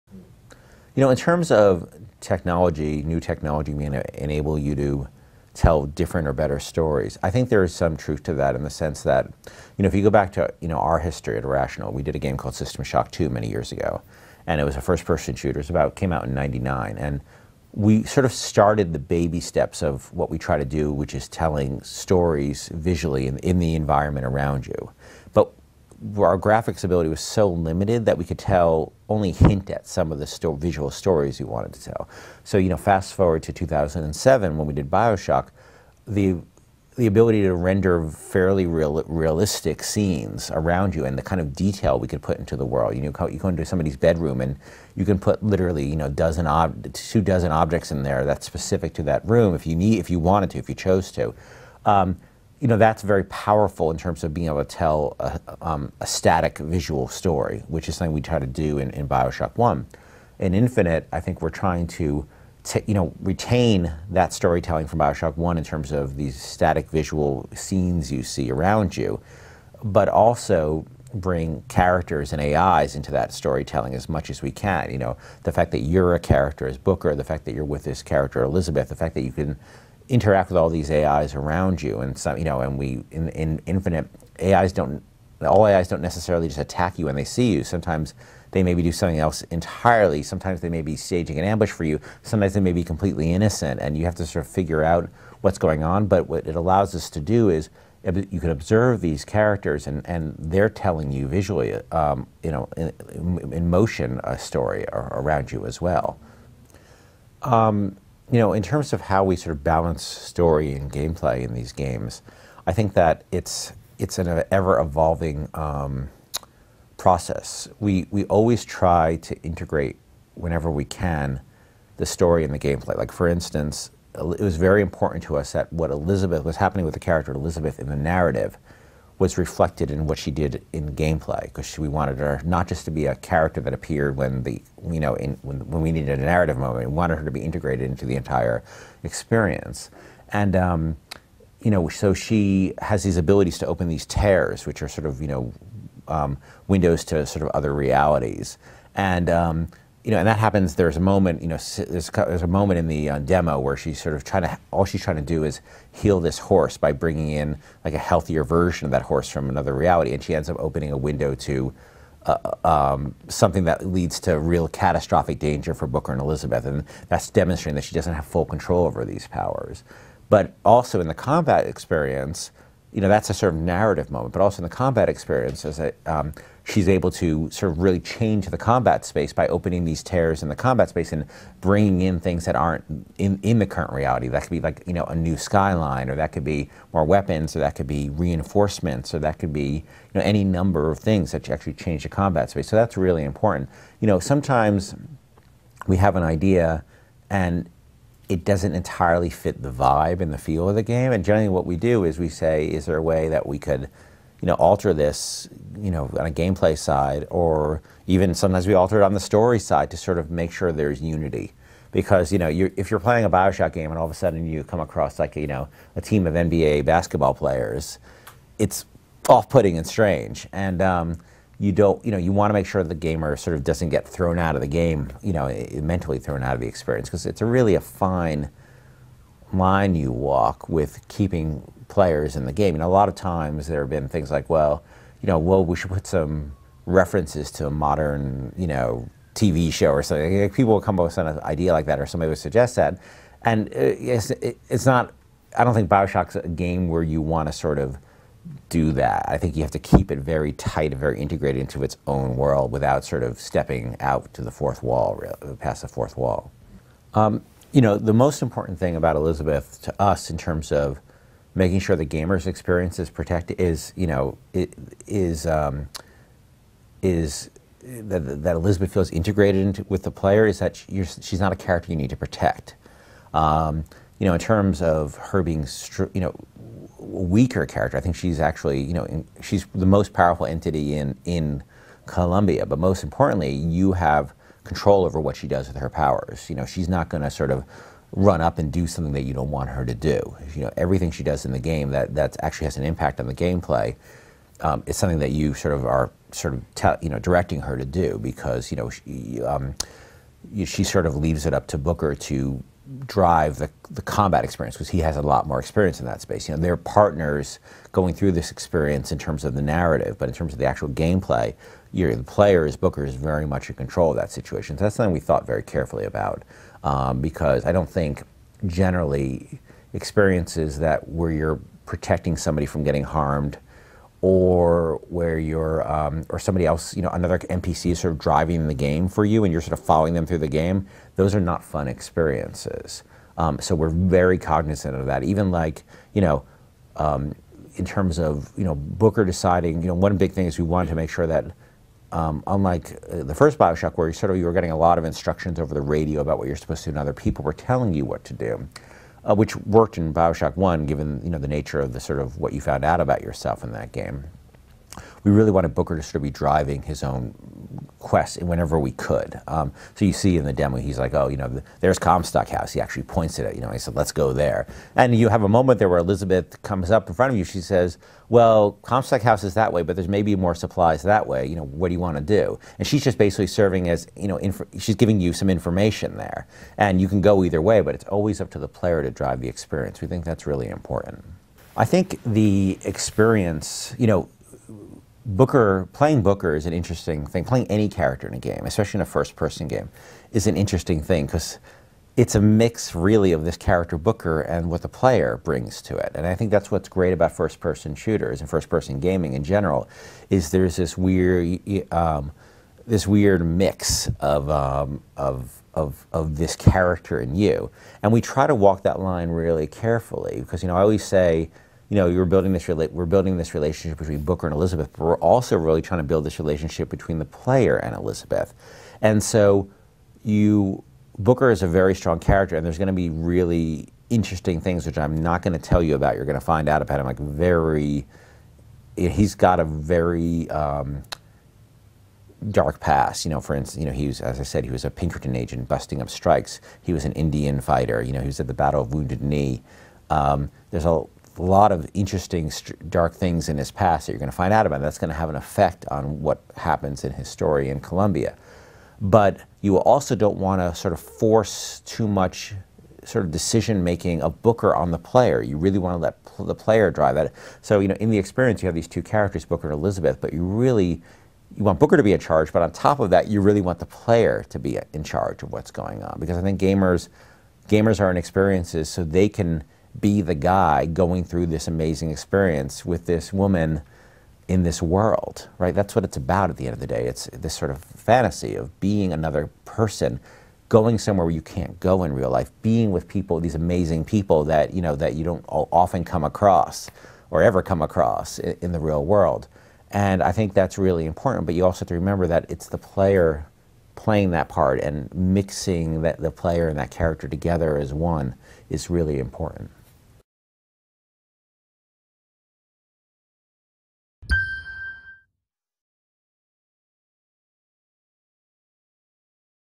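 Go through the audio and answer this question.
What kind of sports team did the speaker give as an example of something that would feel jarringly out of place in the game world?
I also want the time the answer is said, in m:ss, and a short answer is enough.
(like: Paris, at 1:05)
NBA basketball players, at 3:36.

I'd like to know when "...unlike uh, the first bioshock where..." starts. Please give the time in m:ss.
5:42.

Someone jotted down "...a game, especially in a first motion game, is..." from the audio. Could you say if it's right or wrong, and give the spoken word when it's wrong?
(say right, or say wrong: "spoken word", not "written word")
wrong: "person", not "motion".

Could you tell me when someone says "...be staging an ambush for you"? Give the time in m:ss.
1:30.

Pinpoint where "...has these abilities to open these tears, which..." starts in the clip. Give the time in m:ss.
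2:22.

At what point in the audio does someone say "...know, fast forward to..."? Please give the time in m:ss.
0:32.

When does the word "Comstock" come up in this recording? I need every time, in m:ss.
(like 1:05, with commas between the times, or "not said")
6:01, 6:08.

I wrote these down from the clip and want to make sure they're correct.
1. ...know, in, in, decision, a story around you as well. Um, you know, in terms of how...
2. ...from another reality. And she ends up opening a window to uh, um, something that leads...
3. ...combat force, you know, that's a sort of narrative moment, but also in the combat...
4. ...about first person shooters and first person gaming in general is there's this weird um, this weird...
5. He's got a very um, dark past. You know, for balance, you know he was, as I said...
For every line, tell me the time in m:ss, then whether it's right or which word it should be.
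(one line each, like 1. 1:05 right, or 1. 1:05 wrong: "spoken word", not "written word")
1. 1:42 wrong: "motion", not "decision"
2. 2:39 right
3. 2:51 wrong: "experience", not "force"
4. 6:37 right
5. 7:08 wrong: "instance", not "balance".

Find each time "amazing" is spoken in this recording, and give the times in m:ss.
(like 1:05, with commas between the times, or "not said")
7:51, 8:03.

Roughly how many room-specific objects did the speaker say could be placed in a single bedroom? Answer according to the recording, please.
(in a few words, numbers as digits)
two dozen.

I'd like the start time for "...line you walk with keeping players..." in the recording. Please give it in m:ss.
3:49.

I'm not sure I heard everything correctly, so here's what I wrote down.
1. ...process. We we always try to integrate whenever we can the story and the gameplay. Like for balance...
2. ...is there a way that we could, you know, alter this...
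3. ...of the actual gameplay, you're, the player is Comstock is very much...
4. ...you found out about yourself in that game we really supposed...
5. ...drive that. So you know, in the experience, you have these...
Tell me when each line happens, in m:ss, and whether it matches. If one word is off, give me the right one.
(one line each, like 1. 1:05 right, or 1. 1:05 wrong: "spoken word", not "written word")
1. 1:56 wrong: "instance", not "balance"
2. 3:22 right
3. 5:10 wrong: "Booker", not "Comstock"
4. 5:52 wrong: "wanted", not "supposed"
5. 7:36 right.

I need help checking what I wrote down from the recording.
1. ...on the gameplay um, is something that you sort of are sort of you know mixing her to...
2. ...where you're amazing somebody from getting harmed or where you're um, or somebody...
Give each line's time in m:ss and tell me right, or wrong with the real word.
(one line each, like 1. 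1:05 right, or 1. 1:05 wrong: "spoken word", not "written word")
1. 4:53 wrong: "directing", not "mixing"
2. 5:21 wrong: "protecting", not "amazing".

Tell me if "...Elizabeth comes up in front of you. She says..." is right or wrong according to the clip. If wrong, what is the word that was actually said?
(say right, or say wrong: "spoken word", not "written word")
right.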